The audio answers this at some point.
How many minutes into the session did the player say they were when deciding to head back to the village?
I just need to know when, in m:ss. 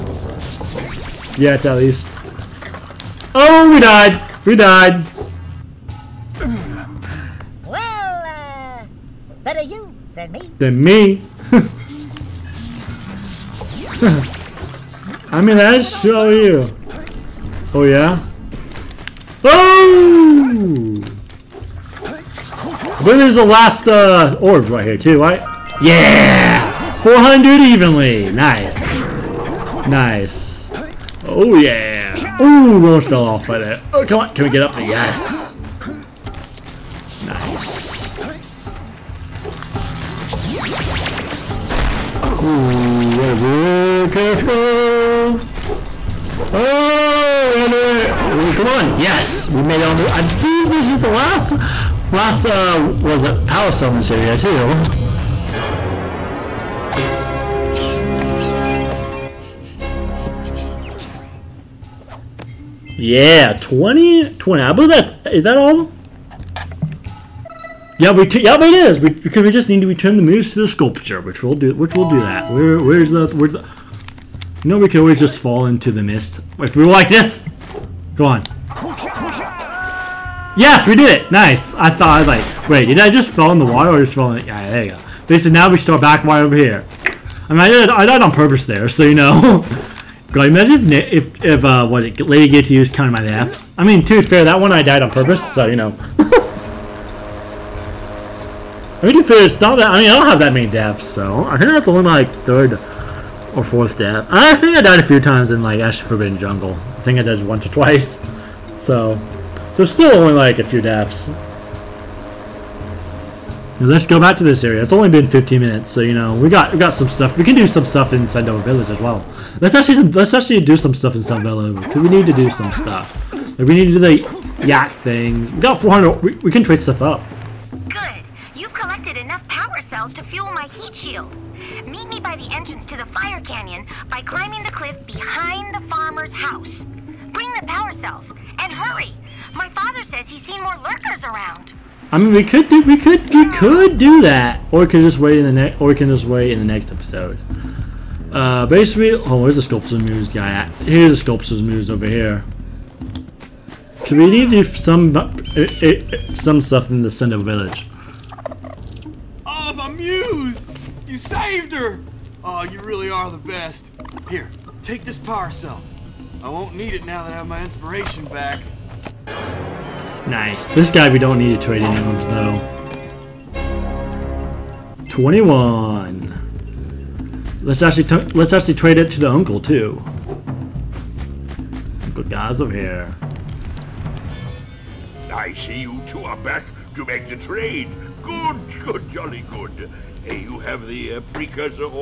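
1:55.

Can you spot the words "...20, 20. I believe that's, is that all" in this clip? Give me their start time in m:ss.
1:03.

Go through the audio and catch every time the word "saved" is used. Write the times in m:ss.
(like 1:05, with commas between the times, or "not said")
2:41.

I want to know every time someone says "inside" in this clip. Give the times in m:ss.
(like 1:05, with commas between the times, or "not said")
1:58.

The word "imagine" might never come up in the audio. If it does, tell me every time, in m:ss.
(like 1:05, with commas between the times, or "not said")
1:30.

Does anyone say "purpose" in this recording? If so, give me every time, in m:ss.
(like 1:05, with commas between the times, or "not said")
1:28, 1:35.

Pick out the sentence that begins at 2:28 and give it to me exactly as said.
Uh, basically, oh, where's the sculptor's muse guy at?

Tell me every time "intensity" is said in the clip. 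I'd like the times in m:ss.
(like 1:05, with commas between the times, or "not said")
not said.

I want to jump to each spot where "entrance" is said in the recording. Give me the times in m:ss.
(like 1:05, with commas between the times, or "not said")
2:12.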